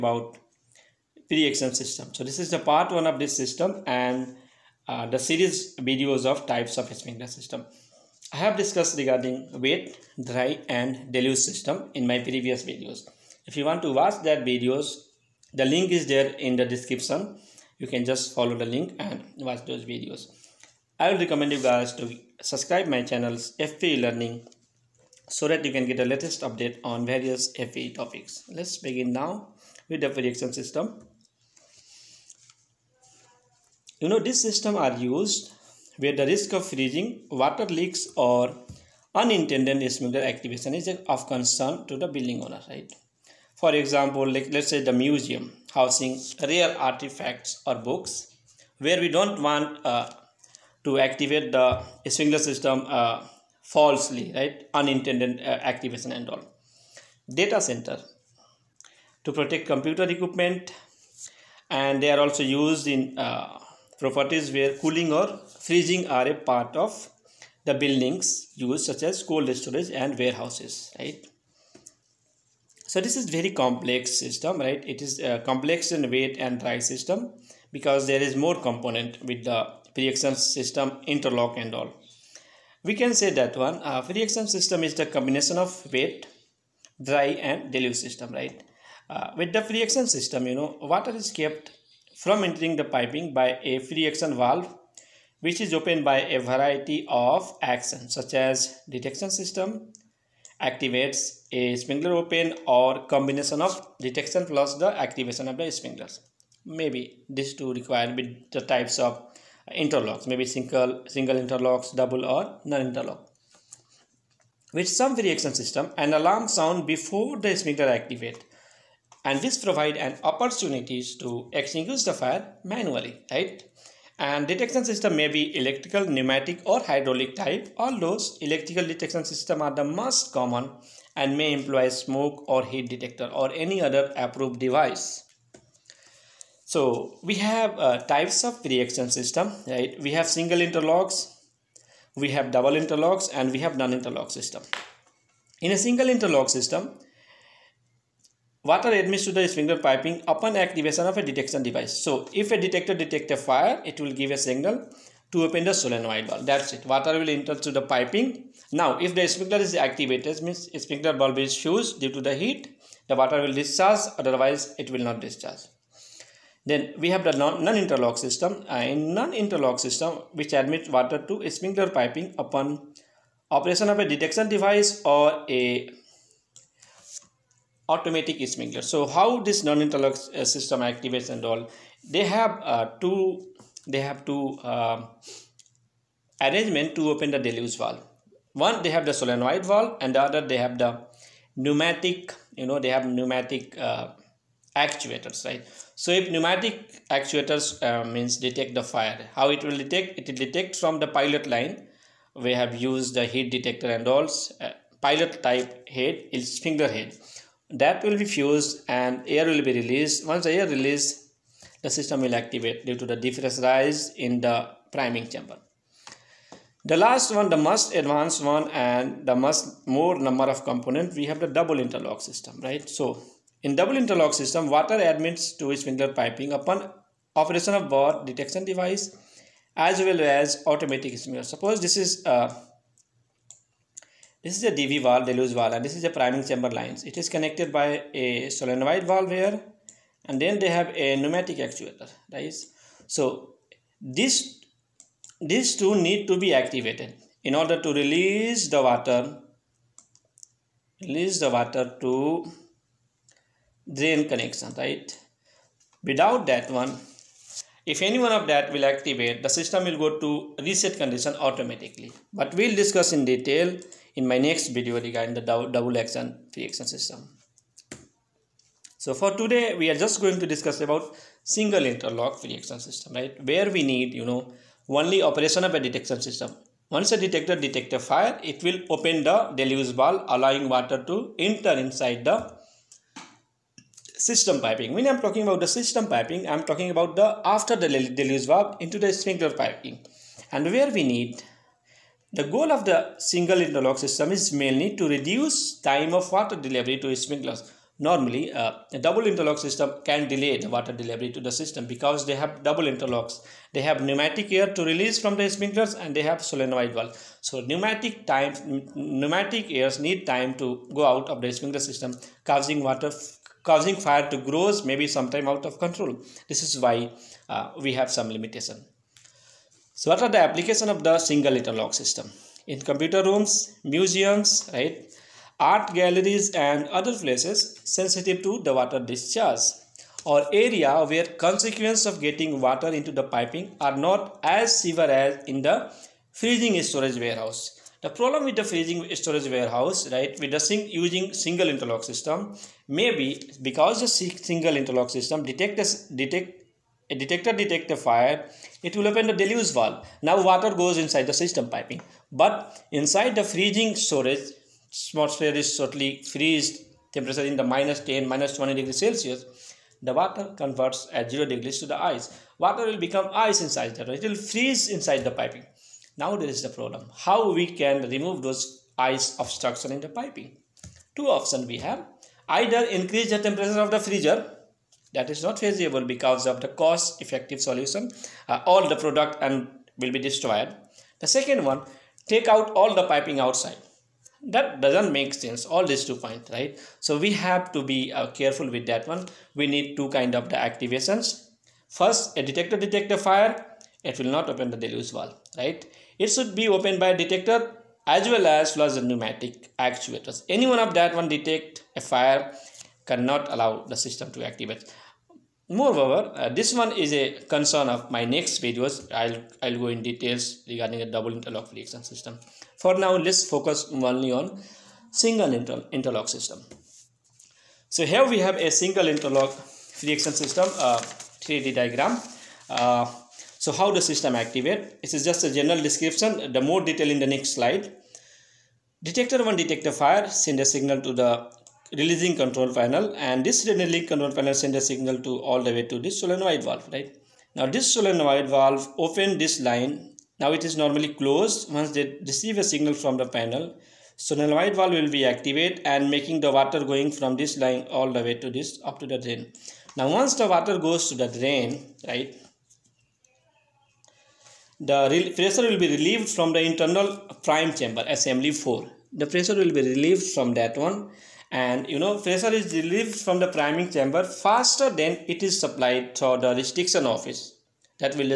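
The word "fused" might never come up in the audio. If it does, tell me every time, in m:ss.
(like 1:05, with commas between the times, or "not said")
2:41, 3:28.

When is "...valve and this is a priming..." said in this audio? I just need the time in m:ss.
3:55.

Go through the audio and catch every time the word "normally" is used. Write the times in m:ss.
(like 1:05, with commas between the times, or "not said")
4:57, 7:20.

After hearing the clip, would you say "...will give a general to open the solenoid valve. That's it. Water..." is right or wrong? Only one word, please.
wrong.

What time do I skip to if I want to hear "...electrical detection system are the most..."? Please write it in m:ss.
2:08.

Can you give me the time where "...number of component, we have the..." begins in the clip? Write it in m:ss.
3:40.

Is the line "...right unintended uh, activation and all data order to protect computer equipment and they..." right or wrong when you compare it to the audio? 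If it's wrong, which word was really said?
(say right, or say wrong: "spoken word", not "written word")
wrong: "center", not "order".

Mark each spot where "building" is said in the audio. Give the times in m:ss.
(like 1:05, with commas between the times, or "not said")
0:42, 1:07.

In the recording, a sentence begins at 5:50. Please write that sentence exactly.
Now water goes inside the system piping.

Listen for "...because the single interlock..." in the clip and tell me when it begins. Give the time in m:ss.
5:43.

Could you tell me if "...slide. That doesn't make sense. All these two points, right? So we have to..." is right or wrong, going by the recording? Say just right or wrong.
wrong.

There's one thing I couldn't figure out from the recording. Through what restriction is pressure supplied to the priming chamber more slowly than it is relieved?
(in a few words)
Restriction orifice.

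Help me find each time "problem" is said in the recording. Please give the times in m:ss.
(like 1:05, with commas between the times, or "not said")
5:38, 6:06.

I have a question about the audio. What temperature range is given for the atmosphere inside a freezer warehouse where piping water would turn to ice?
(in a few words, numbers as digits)
-10 to -20 °C.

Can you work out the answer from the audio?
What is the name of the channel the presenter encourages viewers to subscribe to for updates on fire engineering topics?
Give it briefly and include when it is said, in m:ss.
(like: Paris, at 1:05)
FPE Learning, at 0:23.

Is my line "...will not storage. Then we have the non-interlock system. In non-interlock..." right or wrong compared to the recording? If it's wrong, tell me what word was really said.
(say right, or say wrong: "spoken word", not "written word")
wrong: "discharge", not "storage".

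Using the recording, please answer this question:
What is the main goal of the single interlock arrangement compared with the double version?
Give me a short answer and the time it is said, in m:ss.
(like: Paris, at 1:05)
Reduce time of water delivery, at 4:55.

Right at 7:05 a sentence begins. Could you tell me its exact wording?
This is just a general description, the more detail in the next slide.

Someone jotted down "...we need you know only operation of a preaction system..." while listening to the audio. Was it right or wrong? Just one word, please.
wrong.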